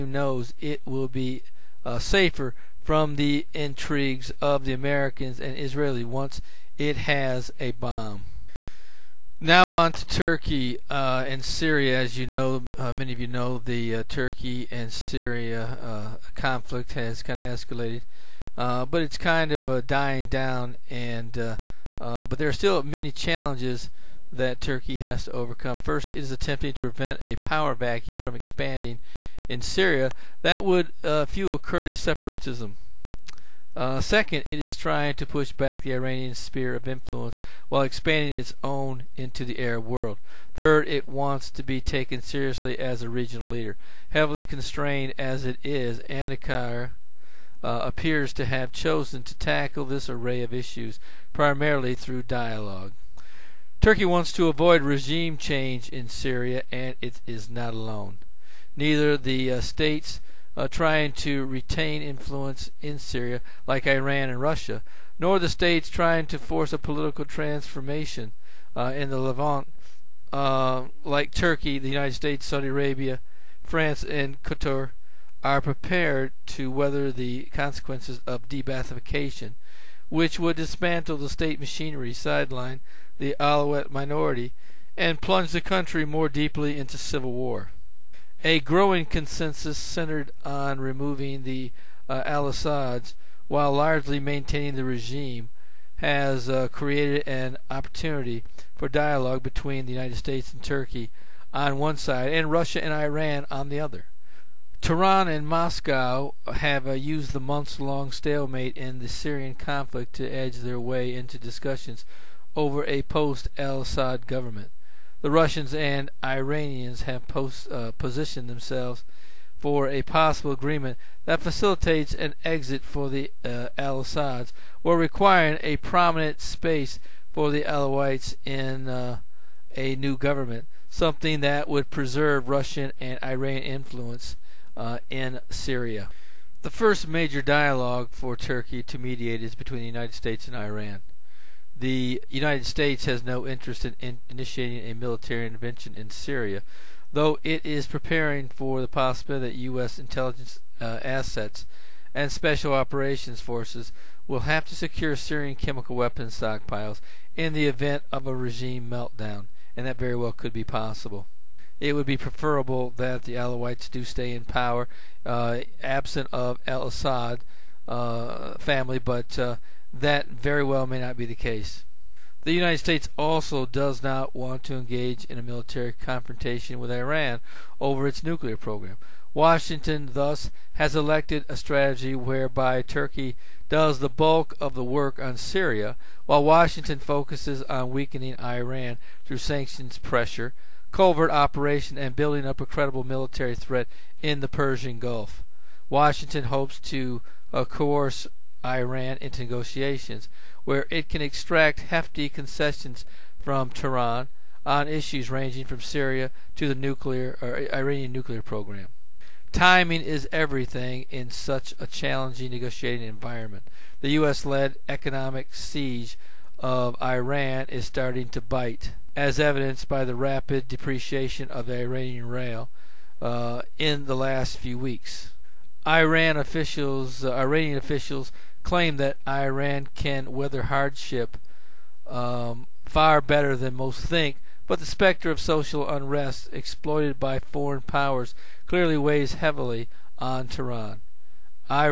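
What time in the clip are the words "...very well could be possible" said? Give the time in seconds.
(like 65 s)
159 s.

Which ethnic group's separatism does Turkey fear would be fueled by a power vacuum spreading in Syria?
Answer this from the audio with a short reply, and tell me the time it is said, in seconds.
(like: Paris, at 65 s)
Kurdish, at 31 s.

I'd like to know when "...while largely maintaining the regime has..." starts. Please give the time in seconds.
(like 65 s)
93 s.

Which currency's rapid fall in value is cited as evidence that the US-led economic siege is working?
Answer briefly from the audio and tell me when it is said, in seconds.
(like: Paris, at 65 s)
Iranian rial, at 221 s.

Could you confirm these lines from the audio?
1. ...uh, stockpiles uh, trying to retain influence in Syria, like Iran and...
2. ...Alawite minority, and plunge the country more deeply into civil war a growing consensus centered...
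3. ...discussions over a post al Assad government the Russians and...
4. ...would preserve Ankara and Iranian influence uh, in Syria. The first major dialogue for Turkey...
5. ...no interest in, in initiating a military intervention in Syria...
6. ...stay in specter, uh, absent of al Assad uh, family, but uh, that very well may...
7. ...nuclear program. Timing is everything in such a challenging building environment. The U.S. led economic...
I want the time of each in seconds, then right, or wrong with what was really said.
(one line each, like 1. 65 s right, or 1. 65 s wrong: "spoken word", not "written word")
1. 59 s wrong: "states", not "stockpiles"
2. 83 s right
3. 111 s right
4. 131 s wrong: "Russian", not "Ankara"
5. 143 s right
6. 164 s wrong: "power", not "specter"
7. 208 s wrong: "negotiating", not "building".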